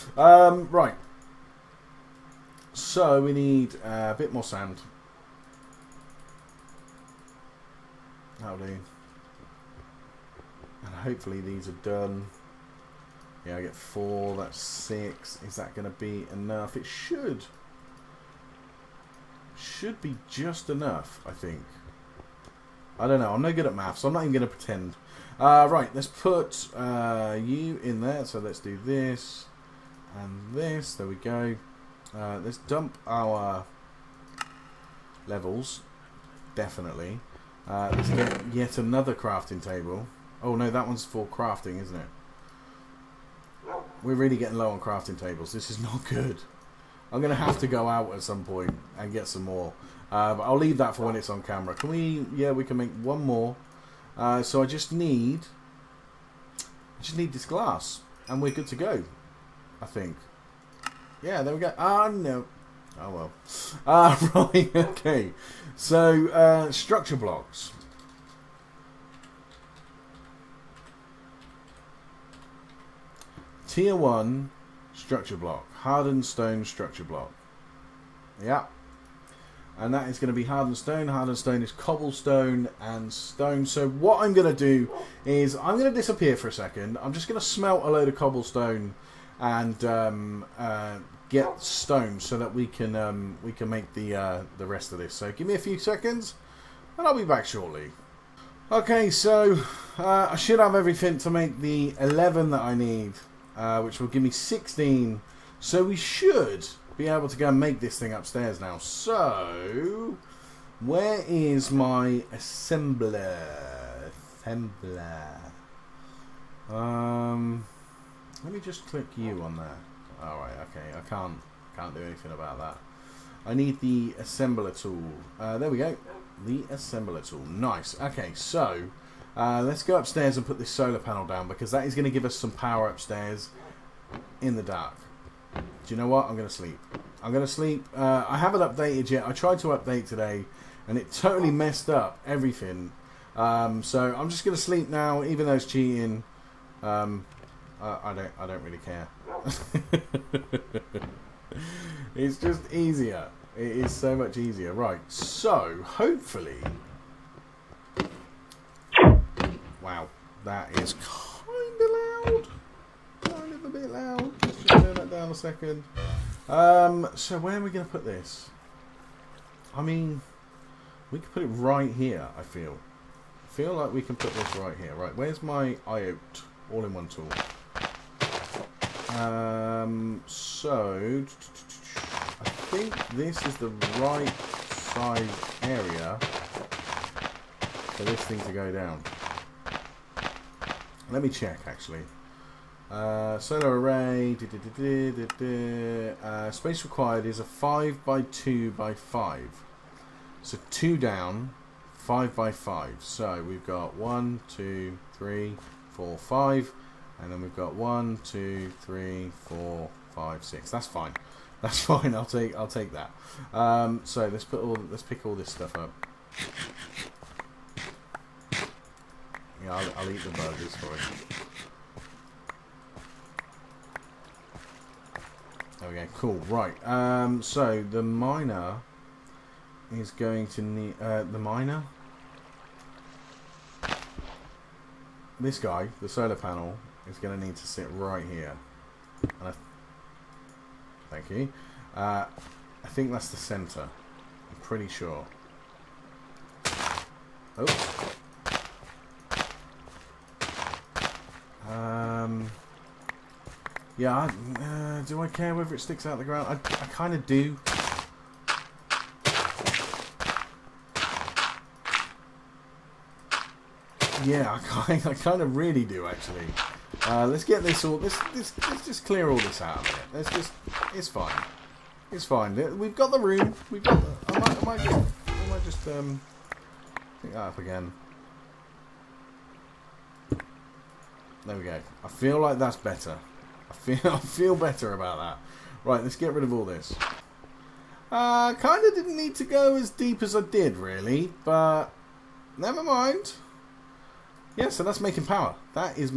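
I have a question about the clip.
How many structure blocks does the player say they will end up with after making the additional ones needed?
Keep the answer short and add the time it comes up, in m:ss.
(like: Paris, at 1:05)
16, at 1:44.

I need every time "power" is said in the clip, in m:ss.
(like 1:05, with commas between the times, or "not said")
2:12, 4:55.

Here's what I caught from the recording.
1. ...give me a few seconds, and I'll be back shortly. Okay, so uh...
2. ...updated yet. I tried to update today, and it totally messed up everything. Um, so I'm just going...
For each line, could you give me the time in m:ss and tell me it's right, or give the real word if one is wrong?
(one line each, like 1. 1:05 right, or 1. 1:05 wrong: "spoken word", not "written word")
1. 1:35 right
2. 2:18 right.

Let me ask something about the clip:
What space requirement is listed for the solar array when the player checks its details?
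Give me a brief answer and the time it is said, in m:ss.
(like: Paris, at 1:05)
5 by 2 by 5, at 3:17.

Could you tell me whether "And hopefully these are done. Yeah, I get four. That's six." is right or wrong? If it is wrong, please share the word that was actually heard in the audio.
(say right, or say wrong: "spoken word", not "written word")
right.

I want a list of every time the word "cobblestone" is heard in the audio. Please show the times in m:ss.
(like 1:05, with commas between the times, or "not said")
1:21, 1:28.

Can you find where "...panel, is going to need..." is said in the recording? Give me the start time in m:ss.
3:56.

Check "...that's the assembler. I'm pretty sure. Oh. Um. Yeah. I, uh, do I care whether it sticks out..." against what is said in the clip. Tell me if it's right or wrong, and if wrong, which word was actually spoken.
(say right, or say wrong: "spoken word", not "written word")
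wrong: "center", not "assembler".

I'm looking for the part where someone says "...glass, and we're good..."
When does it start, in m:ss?
0:57.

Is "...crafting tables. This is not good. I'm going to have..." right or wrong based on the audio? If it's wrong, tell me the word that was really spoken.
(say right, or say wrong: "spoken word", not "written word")
right.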